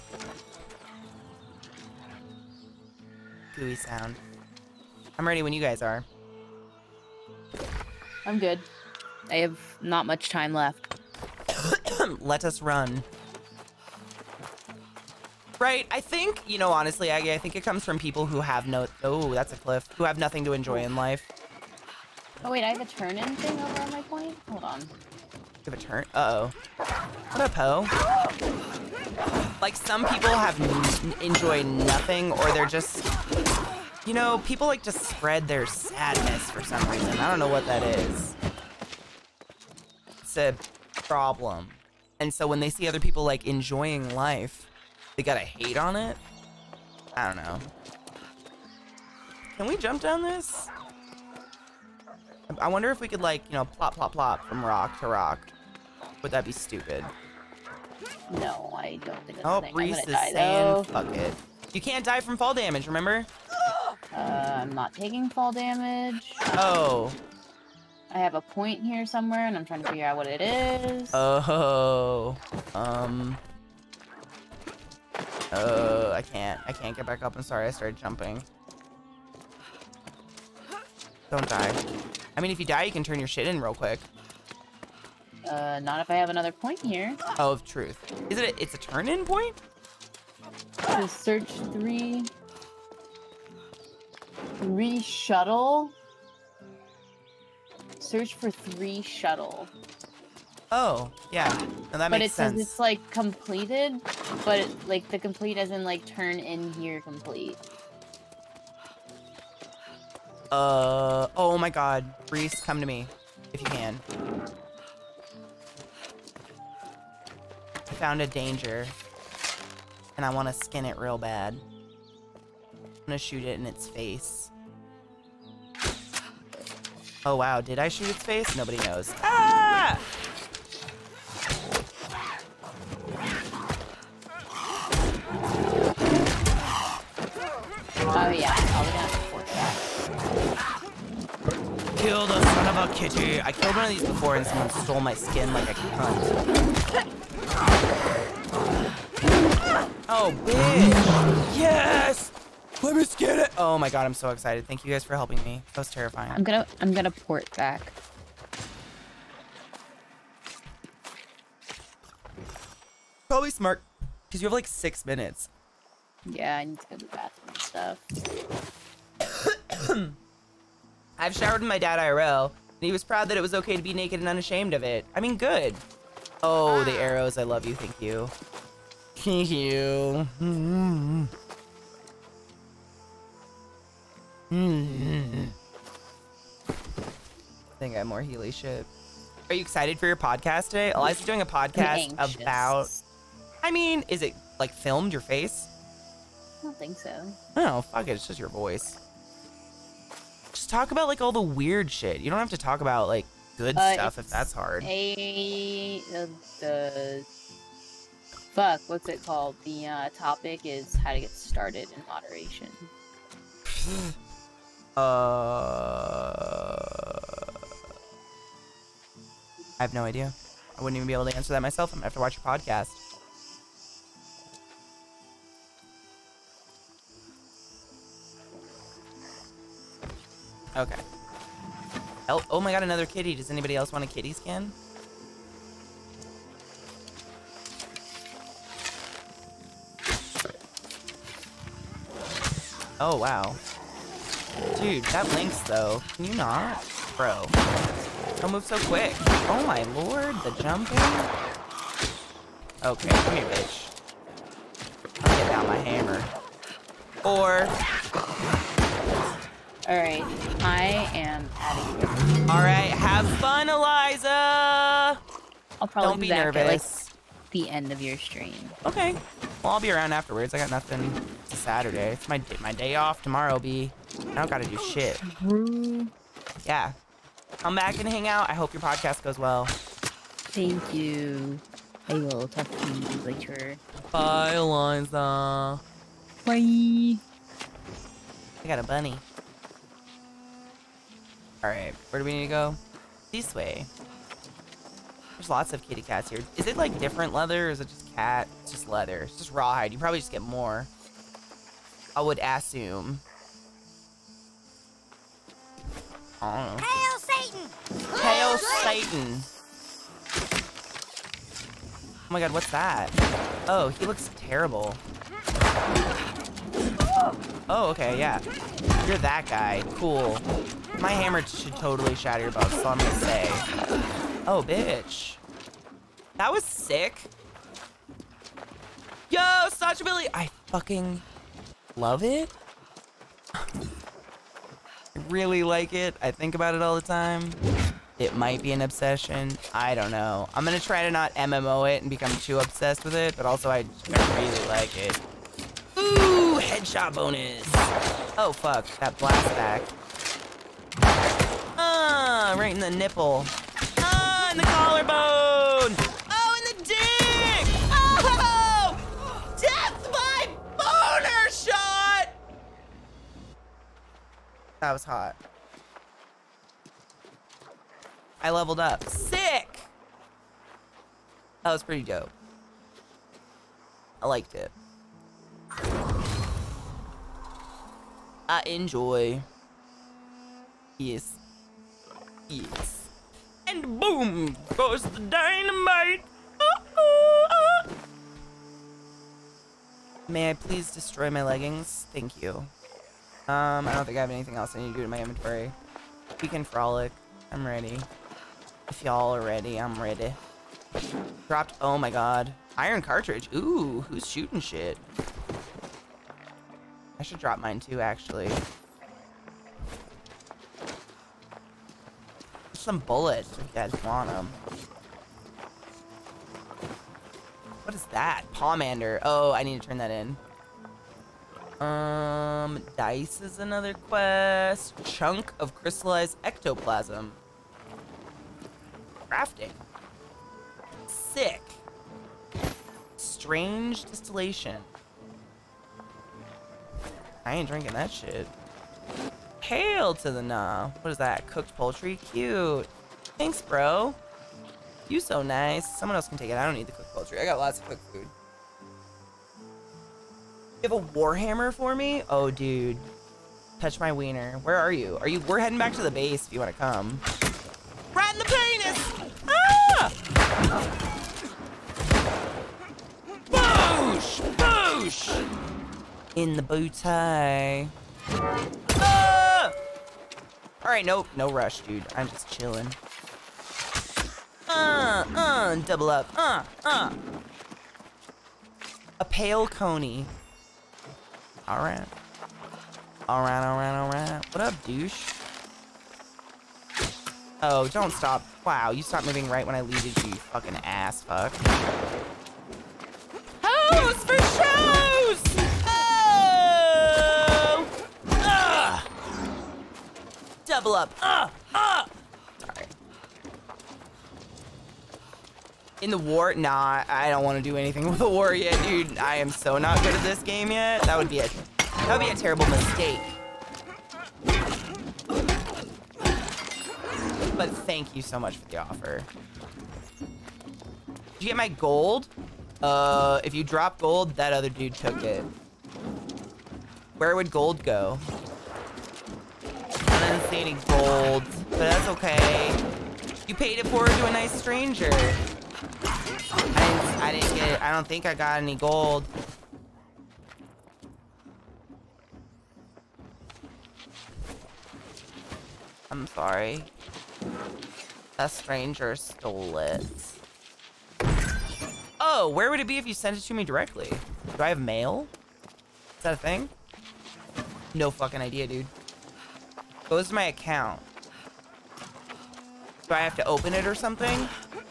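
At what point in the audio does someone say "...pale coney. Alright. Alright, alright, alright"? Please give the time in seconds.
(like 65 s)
479 s.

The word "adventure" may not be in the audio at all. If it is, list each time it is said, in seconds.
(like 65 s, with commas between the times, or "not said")
not said.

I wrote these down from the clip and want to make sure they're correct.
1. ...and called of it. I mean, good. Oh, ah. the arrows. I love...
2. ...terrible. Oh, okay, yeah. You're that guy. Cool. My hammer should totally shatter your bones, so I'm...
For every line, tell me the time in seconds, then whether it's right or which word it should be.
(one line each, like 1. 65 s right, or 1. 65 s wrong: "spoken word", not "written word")
1. 174 s wrong: "unashamed", not "called"
2. 314 s right.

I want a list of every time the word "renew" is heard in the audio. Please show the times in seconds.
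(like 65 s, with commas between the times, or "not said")
not said.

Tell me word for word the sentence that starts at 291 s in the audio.
Alright, where do we need to go?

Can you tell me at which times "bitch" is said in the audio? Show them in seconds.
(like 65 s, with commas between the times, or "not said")
150 s, 253 s, 324 s.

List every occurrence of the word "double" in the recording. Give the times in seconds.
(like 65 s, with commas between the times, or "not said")
475 s, 500 s.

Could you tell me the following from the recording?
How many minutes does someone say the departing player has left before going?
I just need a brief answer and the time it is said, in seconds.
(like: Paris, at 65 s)
6, at 164 s.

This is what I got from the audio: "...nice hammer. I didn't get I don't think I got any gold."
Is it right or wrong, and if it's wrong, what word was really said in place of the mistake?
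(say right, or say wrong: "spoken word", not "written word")
wrong: "stranger", not "hammer".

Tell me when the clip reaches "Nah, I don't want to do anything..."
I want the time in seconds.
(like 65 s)
506 s.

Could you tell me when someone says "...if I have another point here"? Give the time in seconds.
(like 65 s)
85 s.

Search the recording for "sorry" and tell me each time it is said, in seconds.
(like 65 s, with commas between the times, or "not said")
77 s, 546 s.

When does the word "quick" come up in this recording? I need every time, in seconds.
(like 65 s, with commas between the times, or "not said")
83 s, 248 s.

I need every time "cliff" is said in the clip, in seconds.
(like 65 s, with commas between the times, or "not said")
19 s.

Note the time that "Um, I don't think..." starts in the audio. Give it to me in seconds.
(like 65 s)
393 s.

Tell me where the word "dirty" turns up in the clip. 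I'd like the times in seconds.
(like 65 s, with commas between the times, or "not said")
not said.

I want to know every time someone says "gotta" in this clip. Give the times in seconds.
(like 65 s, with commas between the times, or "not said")
45 s, 274 s.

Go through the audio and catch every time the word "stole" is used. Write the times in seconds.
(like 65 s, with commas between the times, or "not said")
144 s, 549 s.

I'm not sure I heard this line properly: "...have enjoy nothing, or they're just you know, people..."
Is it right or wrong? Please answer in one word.
right.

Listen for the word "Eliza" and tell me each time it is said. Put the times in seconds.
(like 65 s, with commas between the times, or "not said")
190 s, 263 s, 284 s.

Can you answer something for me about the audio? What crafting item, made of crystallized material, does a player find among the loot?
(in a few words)
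Chunk of crystallized ectoplasm.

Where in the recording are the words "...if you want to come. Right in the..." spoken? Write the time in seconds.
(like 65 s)
456 s.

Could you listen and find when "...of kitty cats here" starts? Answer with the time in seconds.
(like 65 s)
295 s.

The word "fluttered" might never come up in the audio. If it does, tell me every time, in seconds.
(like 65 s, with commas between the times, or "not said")
not said.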